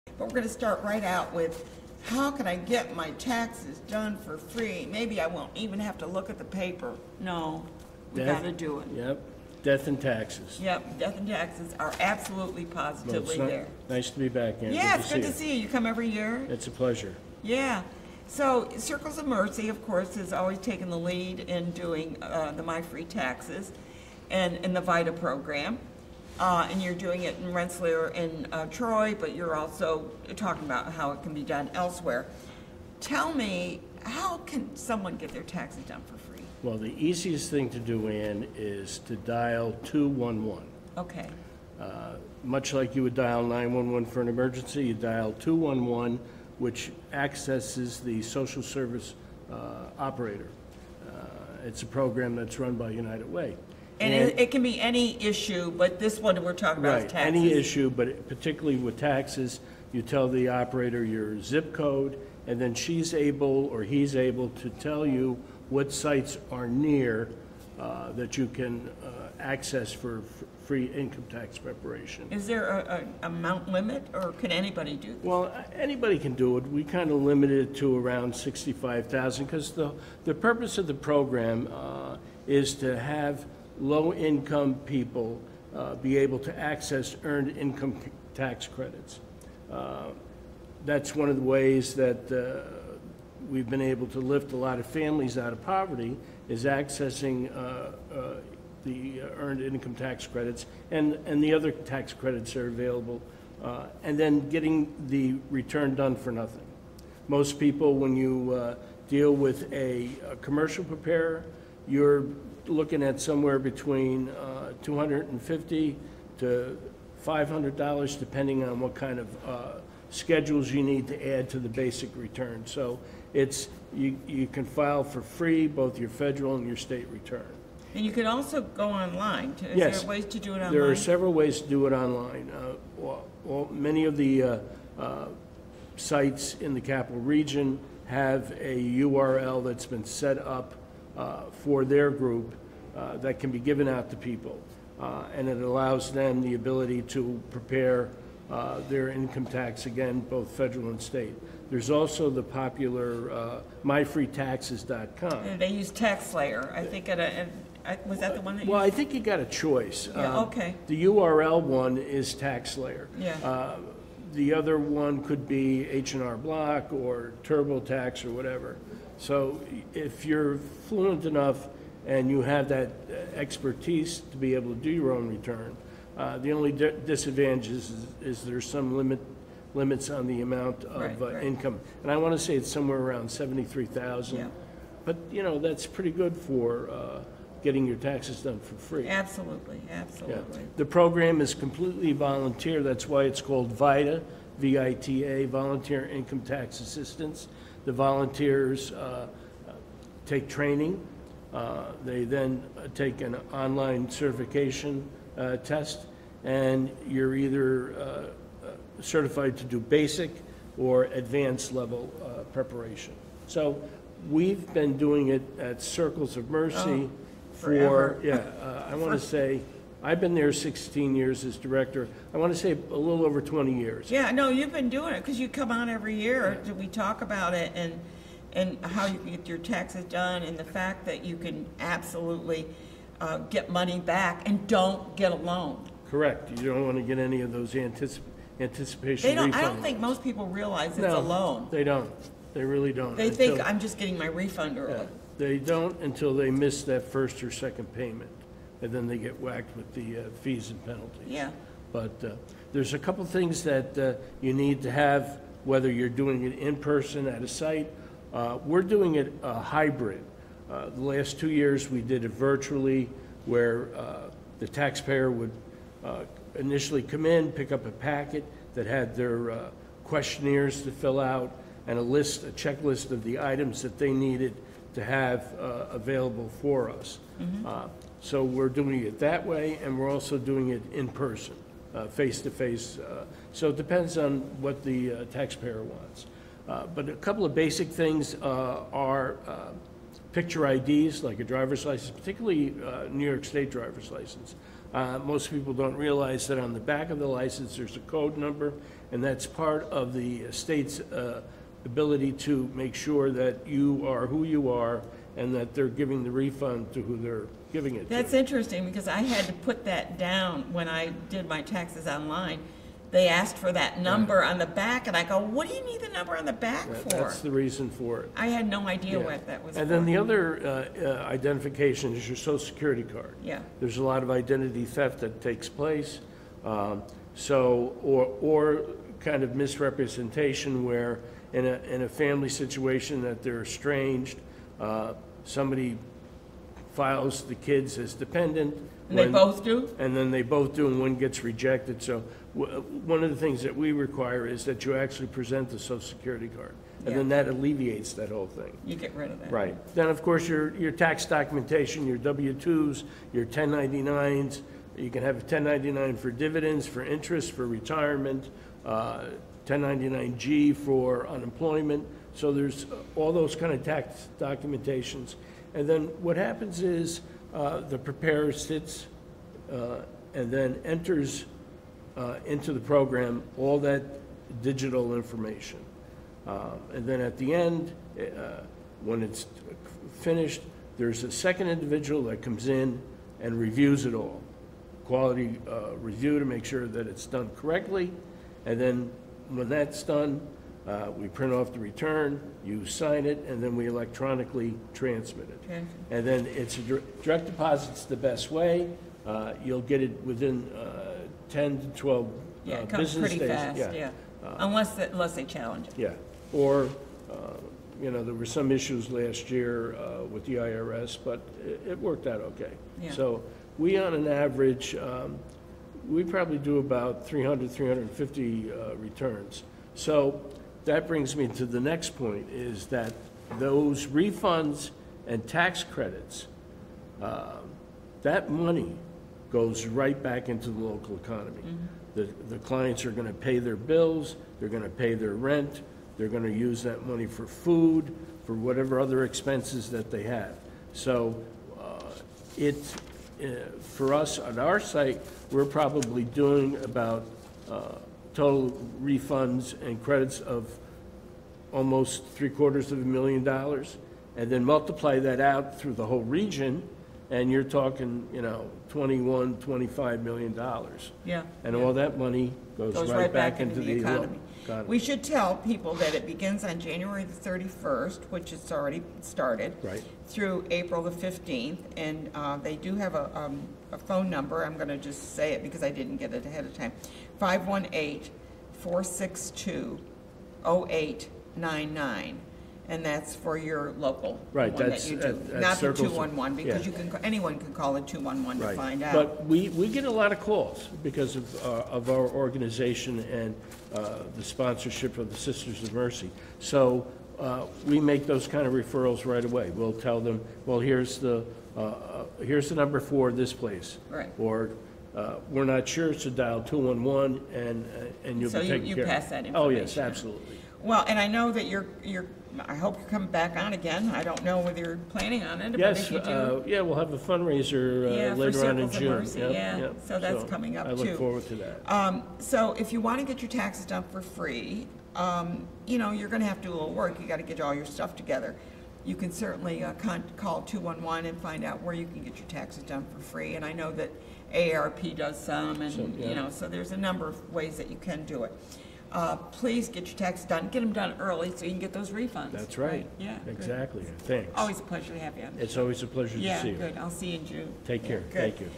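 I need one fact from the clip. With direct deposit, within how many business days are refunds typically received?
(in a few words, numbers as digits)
10 to 12.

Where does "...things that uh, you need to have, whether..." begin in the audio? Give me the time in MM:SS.
04:13.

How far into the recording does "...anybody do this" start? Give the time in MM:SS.
01:14.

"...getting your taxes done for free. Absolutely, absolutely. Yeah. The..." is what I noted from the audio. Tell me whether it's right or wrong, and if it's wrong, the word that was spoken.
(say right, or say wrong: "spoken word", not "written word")
right.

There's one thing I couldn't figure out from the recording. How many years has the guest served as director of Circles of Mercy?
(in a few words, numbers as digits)
16 years.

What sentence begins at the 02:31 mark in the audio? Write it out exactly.
There's also the popular uh, myfreetaxes.com.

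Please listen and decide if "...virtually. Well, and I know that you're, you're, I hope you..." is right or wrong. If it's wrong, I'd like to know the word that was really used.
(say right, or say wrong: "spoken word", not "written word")
wrong: "absolutely", not "virtually".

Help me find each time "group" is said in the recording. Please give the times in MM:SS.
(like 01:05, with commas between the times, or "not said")
02:22.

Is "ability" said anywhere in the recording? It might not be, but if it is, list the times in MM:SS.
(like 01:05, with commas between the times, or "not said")
02:26, 05:01.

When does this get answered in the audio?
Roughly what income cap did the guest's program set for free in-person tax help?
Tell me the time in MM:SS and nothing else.
01:18.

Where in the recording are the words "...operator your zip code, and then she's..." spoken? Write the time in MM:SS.
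01:00.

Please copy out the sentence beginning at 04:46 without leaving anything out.
Uh, but a couple of basic things uh, are uh, picture IDs, like a driver's license, particularly New York State driver's license.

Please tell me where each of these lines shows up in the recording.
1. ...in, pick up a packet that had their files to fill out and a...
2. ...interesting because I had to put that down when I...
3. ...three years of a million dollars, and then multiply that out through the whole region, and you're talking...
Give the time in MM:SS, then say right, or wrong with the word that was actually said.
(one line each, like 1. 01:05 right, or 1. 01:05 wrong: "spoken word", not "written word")
1. 04:27 wrong: "questionnaires", not "files"
2. 05:08 right
3. 07:32 wrong: "quarters", not "years".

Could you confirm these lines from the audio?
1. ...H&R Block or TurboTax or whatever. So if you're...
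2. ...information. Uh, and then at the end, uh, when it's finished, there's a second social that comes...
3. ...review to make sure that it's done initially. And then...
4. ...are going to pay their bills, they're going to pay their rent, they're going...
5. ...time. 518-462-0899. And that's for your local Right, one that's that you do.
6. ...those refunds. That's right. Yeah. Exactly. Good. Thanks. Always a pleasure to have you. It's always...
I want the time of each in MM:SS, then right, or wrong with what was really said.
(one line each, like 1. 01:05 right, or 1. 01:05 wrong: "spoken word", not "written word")
1. 02:45 right
2. 06:15 wrong: "individual", not "social"
3. 06:25 wrong: "correctly", not "initially"
4. 07:13 right
5. 07:56 right
6. 09:01 right.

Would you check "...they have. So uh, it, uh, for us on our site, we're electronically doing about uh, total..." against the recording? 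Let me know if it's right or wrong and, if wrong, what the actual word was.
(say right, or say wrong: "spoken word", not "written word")
wrong: "probably", not "electronically".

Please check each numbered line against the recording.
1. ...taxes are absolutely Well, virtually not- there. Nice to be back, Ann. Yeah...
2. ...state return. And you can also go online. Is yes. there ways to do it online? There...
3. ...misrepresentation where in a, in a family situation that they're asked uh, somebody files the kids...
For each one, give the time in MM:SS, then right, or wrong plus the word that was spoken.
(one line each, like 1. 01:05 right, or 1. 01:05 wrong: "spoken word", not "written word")
1. 00:11 wrong: "positively", not "virtually"
2. 02:06 right
3. 05:29 wrong: "estranged", not "asked".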